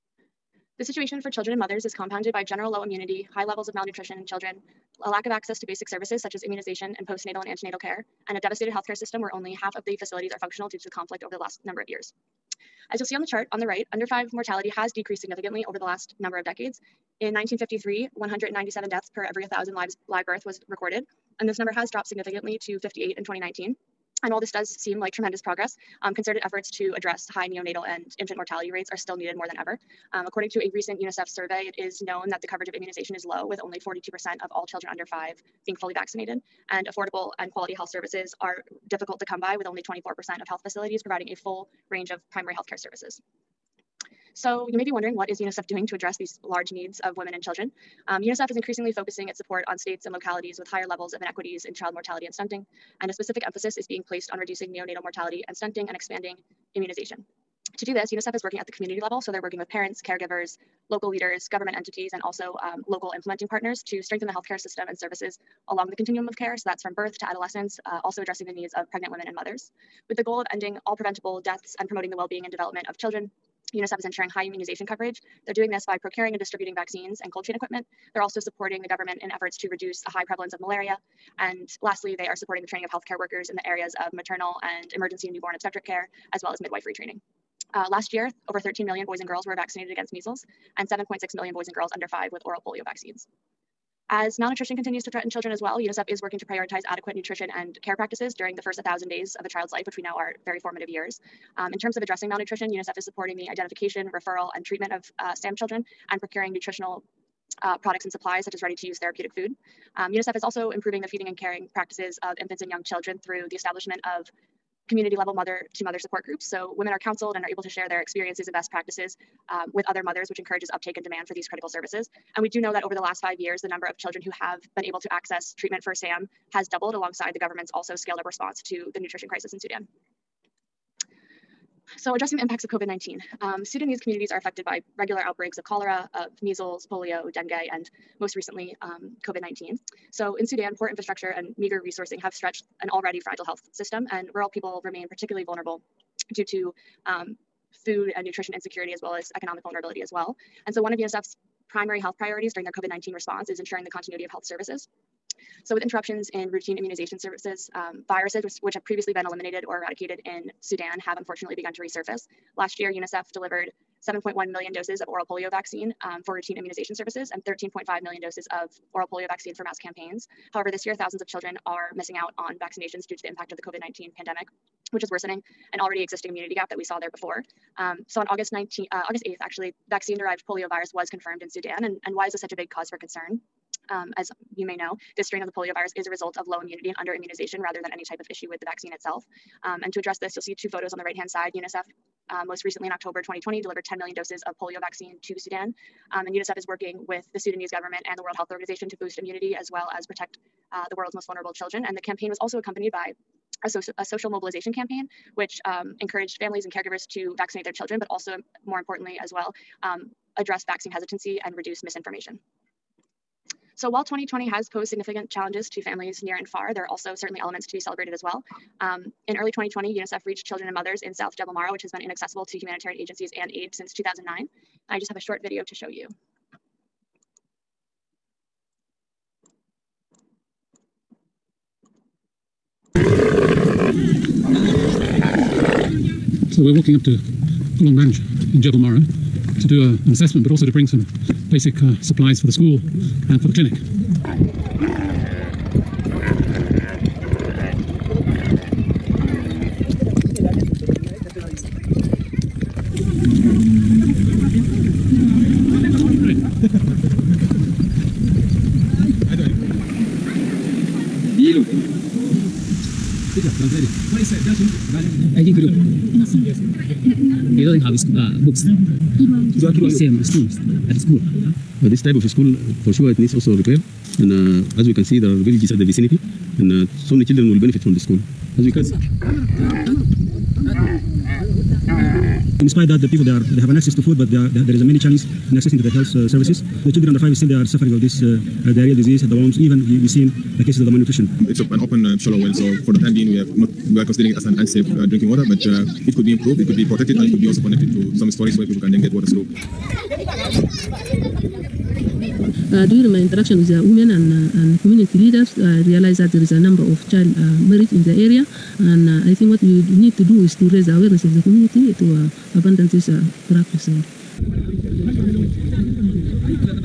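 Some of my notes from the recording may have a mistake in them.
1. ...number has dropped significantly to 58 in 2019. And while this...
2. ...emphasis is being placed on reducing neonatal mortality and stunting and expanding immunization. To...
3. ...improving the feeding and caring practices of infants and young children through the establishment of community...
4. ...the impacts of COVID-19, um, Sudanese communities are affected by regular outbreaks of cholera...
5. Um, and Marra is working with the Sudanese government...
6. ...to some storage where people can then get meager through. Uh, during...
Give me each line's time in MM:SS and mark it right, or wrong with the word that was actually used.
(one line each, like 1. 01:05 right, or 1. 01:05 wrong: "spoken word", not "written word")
1. 00:21 right
2. 00:53 right
3. 01:50 right
4. 02:12 right
5. 03:16 wrong: "UNICEF", not "Marra"
6. 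04:57 wrong: "water", not "meager".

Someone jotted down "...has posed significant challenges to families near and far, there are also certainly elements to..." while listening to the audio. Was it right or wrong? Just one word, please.
right.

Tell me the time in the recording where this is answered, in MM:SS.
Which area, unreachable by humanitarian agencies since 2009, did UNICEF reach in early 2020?
03:41.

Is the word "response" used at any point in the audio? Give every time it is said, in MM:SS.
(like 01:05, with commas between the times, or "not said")
02:08, 02:33.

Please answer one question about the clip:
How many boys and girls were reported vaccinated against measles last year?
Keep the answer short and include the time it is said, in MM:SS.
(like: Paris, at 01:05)
over 13 million, at 01:28.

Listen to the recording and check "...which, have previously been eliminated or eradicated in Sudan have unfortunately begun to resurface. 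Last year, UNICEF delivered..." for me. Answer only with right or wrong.
right.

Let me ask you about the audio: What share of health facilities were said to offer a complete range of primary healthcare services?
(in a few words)
24%.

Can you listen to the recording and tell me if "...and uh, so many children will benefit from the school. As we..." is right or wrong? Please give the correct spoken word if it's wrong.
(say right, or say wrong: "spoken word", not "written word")
right.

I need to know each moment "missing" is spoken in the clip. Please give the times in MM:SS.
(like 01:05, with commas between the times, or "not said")
02:51.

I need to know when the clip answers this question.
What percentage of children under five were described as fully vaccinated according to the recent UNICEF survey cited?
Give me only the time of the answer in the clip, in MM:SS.
00:33.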